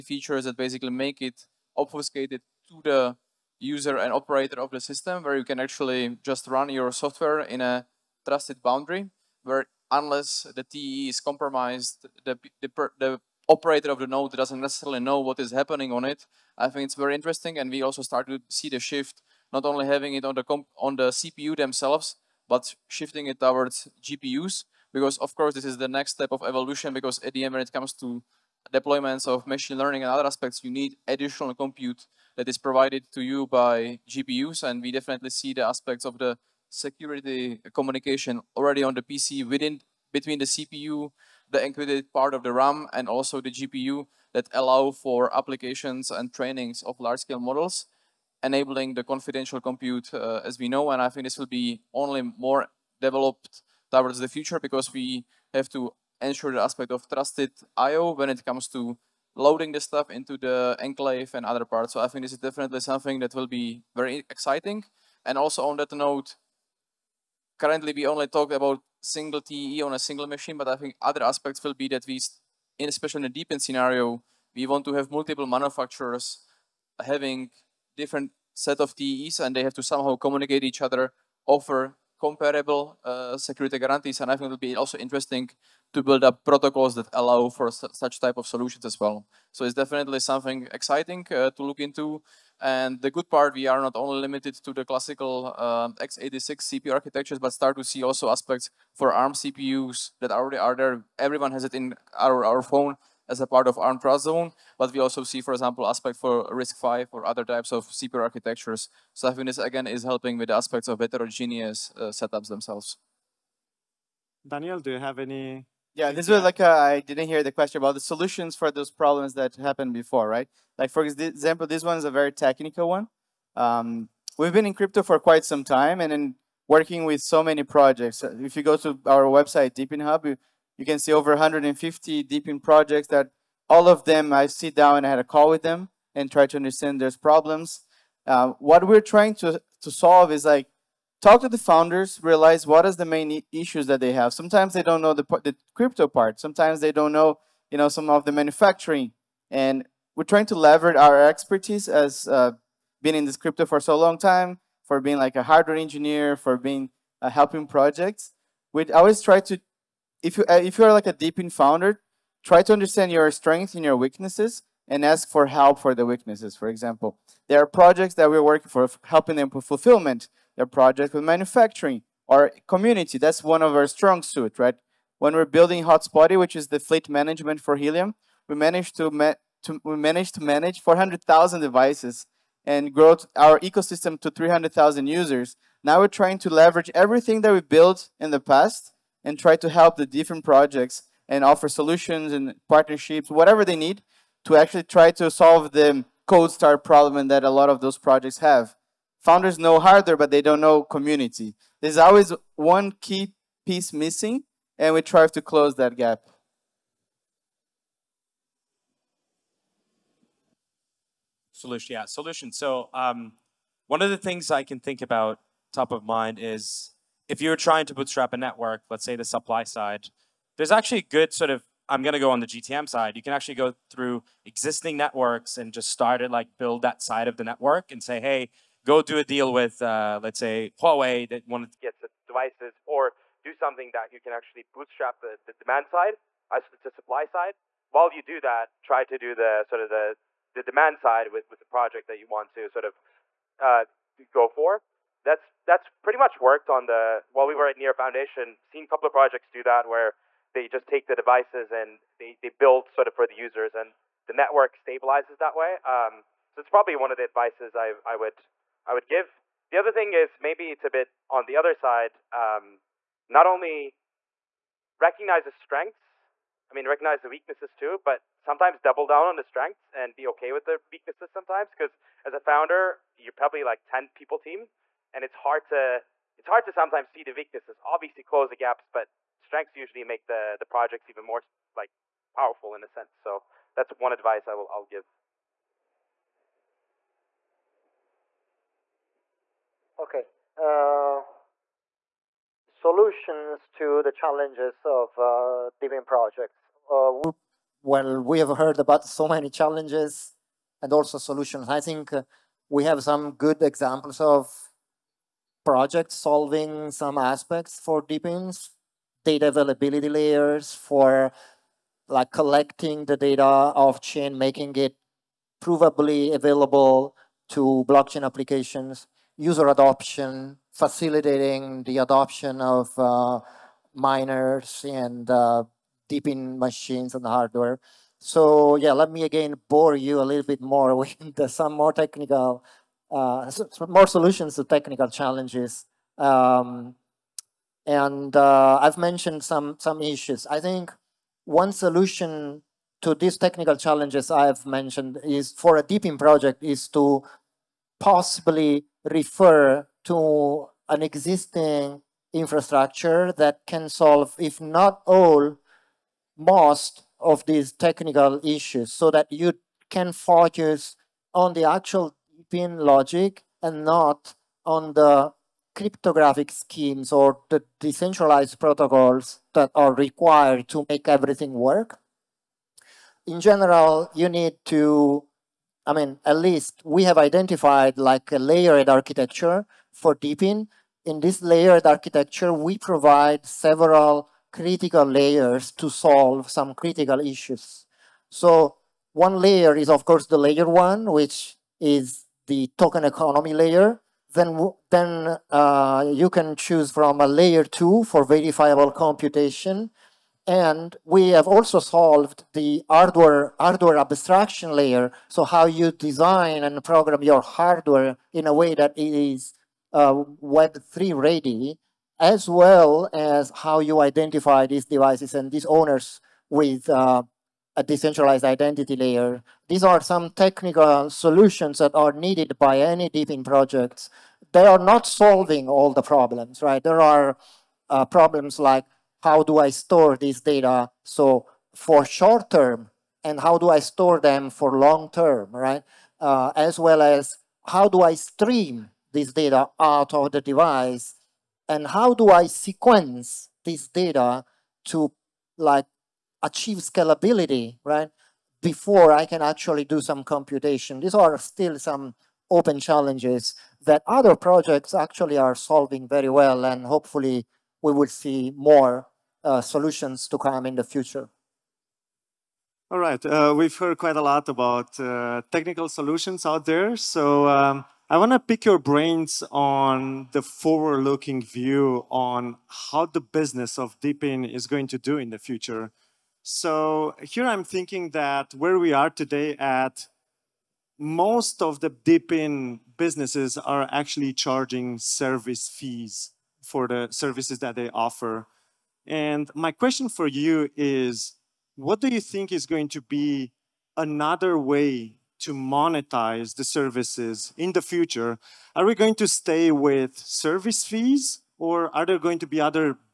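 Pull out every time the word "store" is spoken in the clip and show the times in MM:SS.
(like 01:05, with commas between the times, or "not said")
07:09, 07:13.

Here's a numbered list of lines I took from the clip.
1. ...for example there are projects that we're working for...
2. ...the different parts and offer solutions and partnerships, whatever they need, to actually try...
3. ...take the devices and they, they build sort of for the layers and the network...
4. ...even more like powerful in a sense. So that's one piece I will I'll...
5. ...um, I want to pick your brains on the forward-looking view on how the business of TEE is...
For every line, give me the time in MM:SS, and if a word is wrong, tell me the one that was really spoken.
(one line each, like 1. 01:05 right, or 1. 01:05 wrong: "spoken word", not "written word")
1. 02:46 right
2. 03:09 wrong: "projects", not "parts"
3. 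04:10 wrong: "users", not "layers"
4. 04:41 wrong: "advice", not "piece"
5. 07:47 wrong: "DePIN", not "TEE".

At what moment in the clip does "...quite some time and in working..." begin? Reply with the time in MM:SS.
02:05.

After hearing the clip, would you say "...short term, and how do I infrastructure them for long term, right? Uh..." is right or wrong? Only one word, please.
wrong.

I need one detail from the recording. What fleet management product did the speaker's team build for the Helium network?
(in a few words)
Hotspotty.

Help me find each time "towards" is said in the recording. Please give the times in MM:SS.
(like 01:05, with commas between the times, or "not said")
00:23, 00:53.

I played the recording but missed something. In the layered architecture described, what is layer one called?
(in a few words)
token economy layer.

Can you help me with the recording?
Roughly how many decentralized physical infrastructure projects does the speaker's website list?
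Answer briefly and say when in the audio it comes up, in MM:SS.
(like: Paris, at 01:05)
over 150, at 02:11.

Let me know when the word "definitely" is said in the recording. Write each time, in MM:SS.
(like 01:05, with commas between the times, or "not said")
00:34, 01:02, 01:29.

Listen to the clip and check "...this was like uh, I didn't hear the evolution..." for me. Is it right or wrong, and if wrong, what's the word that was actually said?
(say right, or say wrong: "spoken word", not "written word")
wrong: "question", not "evolution".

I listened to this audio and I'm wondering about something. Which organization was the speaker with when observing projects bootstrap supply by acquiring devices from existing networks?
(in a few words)
Near Foundation.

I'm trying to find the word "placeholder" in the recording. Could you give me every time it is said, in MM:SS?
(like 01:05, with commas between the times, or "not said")
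not said.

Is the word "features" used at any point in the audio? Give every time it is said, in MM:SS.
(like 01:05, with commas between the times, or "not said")
00:00.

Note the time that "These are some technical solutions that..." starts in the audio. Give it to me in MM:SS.
06:59.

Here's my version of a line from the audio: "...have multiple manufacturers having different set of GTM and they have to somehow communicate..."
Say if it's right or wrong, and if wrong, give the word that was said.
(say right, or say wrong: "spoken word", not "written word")
wrong: "TEs", not "GTM".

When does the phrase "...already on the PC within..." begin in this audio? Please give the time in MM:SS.
00:38.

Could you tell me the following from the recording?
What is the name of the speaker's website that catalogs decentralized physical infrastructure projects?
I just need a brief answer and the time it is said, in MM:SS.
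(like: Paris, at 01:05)
DePIN Hub, at 02:09.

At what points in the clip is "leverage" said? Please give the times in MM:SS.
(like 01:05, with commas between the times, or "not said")
02:30, 03:06.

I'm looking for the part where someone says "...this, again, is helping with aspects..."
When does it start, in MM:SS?
01:49.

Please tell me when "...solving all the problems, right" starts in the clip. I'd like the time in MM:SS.
07:05.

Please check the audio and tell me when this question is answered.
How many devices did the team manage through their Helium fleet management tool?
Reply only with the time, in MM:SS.
03:00.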